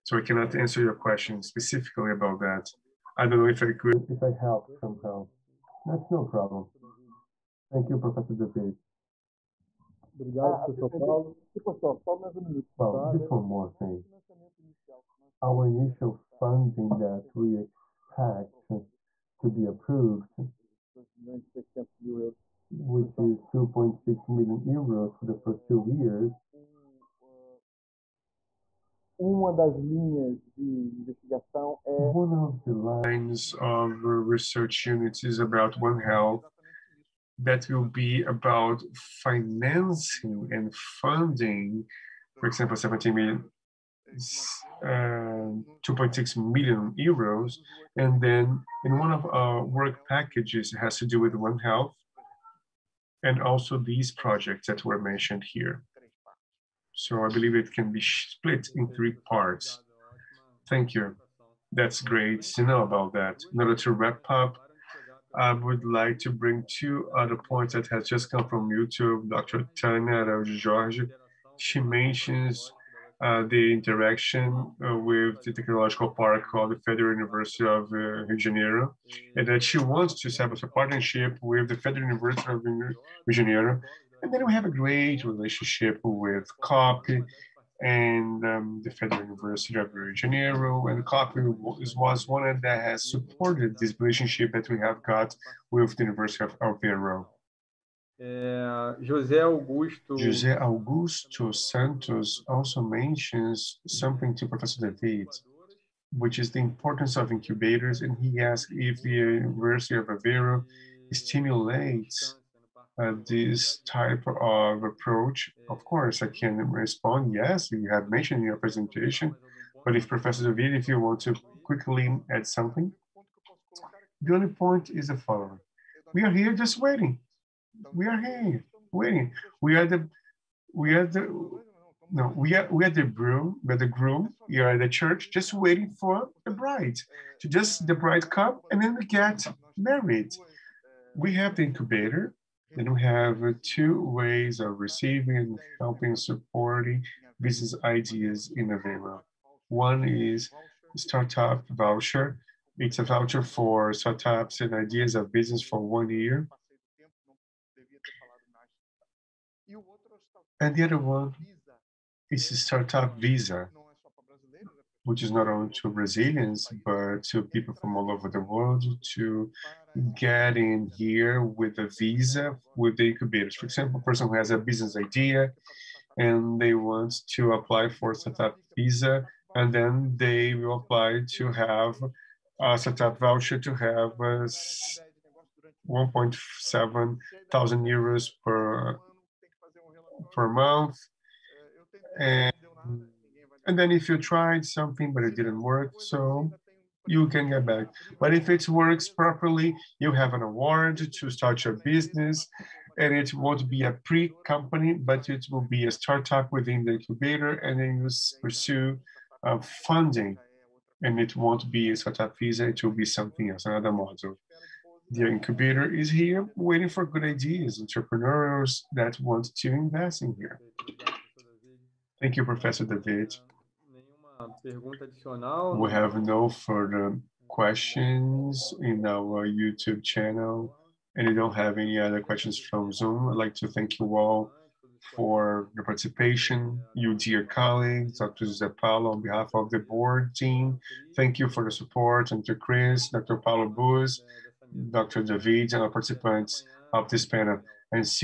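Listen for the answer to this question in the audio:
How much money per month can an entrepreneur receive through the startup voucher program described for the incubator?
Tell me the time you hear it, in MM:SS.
03:05.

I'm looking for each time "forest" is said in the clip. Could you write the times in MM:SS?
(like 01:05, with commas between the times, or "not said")
not said.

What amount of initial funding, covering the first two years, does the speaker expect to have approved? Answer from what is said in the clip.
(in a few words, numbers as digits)
2.6 million euros.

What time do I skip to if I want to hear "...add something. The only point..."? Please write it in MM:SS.
02:02.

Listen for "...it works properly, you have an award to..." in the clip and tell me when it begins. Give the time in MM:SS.
03:18.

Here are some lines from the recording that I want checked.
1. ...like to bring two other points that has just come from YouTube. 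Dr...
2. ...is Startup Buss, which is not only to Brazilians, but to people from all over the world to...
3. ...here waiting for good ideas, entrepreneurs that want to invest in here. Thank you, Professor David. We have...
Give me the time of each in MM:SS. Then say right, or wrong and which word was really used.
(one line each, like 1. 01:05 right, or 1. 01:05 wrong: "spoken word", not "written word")
1. 01:05 right
2. 02:42 wrong: "Visa", not "Buss"
3. 03:36 right.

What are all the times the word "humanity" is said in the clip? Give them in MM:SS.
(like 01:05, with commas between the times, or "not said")
not said.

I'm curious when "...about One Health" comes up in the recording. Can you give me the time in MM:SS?
00:35.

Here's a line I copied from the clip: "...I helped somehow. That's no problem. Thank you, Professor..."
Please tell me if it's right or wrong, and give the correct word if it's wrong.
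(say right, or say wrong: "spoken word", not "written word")
right.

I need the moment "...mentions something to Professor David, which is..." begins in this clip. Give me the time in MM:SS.
01:42.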